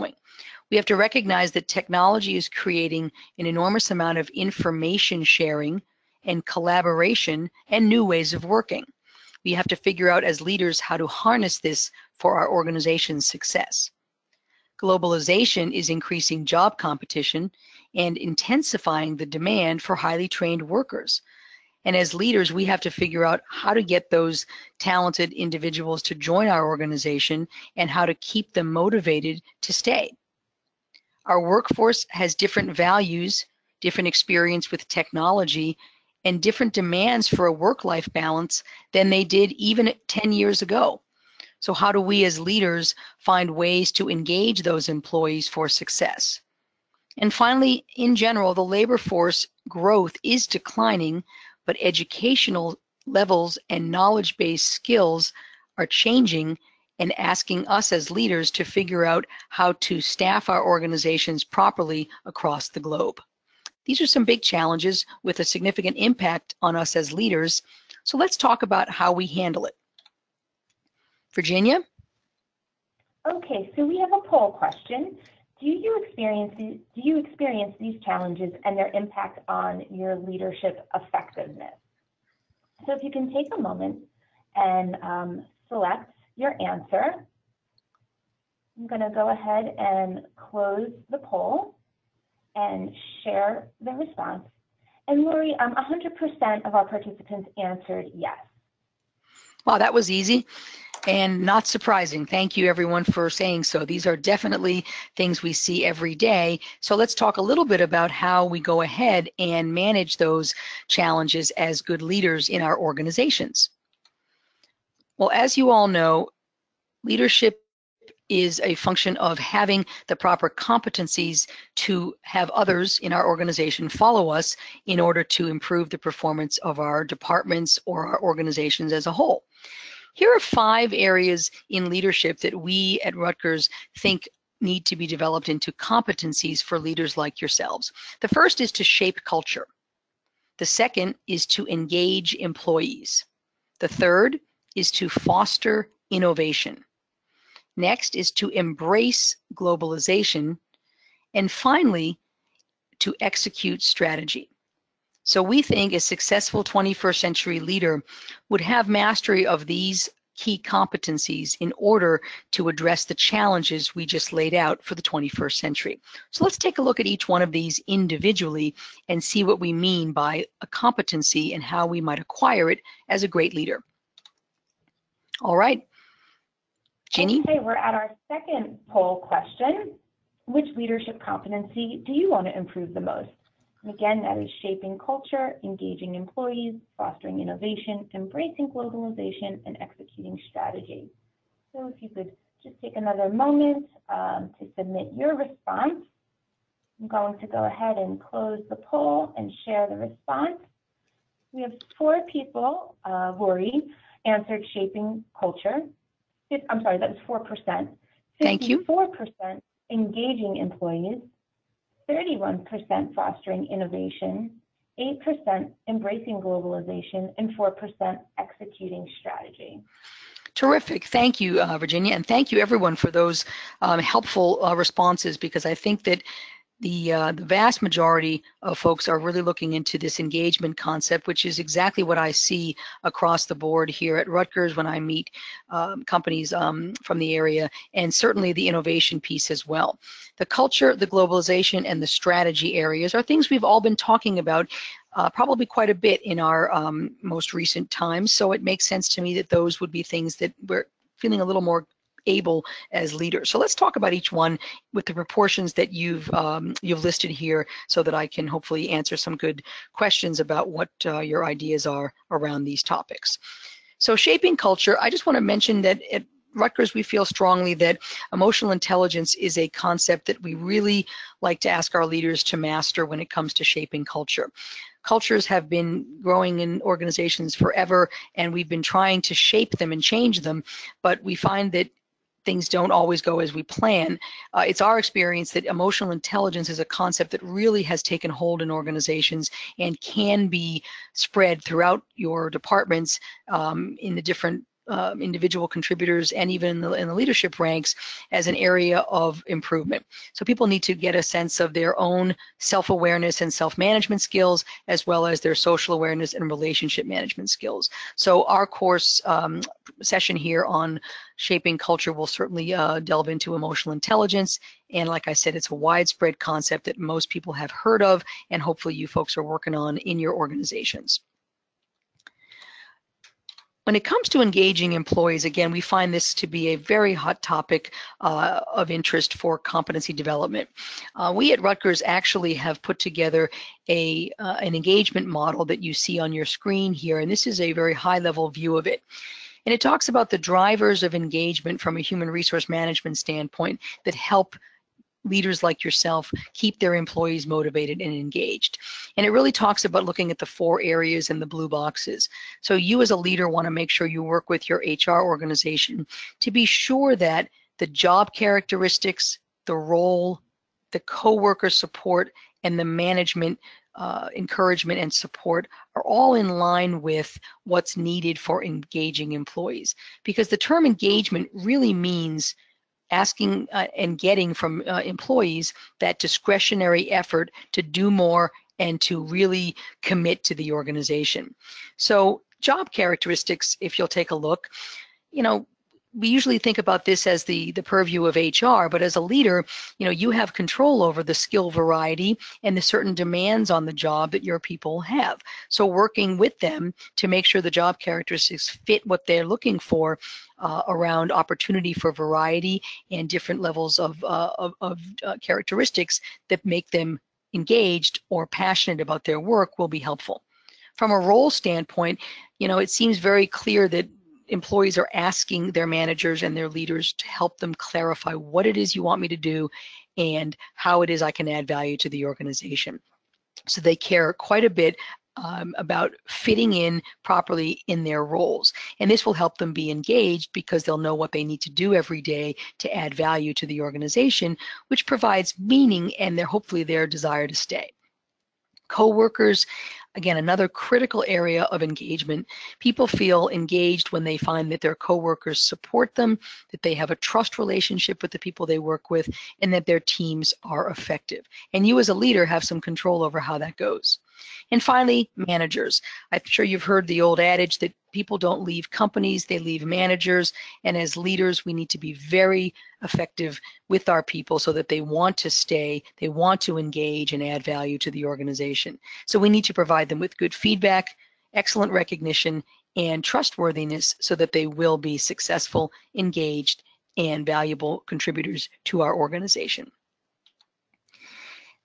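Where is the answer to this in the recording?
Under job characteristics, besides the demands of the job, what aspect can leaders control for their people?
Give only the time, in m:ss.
6:31.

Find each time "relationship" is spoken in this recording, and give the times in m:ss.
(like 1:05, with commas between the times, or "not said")
5:06, 7:27.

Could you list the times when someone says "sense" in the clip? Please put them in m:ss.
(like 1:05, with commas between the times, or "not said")
4:08, 5:01.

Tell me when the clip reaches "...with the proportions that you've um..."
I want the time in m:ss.
4:14.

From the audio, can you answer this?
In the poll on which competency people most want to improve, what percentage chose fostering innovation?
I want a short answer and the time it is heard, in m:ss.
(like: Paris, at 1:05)
8%, at 3:34.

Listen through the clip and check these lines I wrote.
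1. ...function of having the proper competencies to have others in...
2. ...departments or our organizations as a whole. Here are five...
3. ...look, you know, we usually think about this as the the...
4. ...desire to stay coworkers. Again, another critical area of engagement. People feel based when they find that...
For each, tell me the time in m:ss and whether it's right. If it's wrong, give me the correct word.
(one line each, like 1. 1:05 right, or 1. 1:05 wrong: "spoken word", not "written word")
1. 1:58 right
2. 2:07 right
3. 6:24 right
4. 7:17 wrong: "engaged", not "based".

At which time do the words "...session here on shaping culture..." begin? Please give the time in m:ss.
5:10.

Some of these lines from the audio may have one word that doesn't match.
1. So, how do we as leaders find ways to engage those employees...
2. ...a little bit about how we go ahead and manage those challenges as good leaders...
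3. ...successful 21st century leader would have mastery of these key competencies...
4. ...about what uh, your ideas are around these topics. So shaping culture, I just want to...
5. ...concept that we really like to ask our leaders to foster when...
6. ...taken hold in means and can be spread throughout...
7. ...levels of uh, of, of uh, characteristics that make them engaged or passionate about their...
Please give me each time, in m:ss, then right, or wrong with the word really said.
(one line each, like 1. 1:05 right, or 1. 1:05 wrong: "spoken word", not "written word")
1. 0:41 right
2. 1:47 right
3. 2:36 right
4. 4:20 right
5. 4:29 wrong: "master", not "foster"
6. 4:48 wrong: "organizations", not "means"
7. 6:43 right.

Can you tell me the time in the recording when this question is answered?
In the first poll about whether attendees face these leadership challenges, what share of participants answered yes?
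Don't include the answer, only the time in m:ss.
1:35.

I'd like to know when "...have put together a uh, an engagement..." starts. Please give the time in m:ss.
5:32.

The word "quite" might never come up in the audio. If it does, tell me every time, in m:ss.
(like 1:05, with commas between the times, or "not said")
4:05, 7:04.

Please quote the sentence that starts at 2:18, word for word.
The first is to shape culture.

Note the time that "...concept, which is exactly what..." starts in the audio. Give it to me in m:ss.
3:50.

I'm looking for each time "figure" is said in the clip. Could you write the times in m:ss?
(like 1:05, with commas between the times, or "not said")
0:09, 0:22, 0:58.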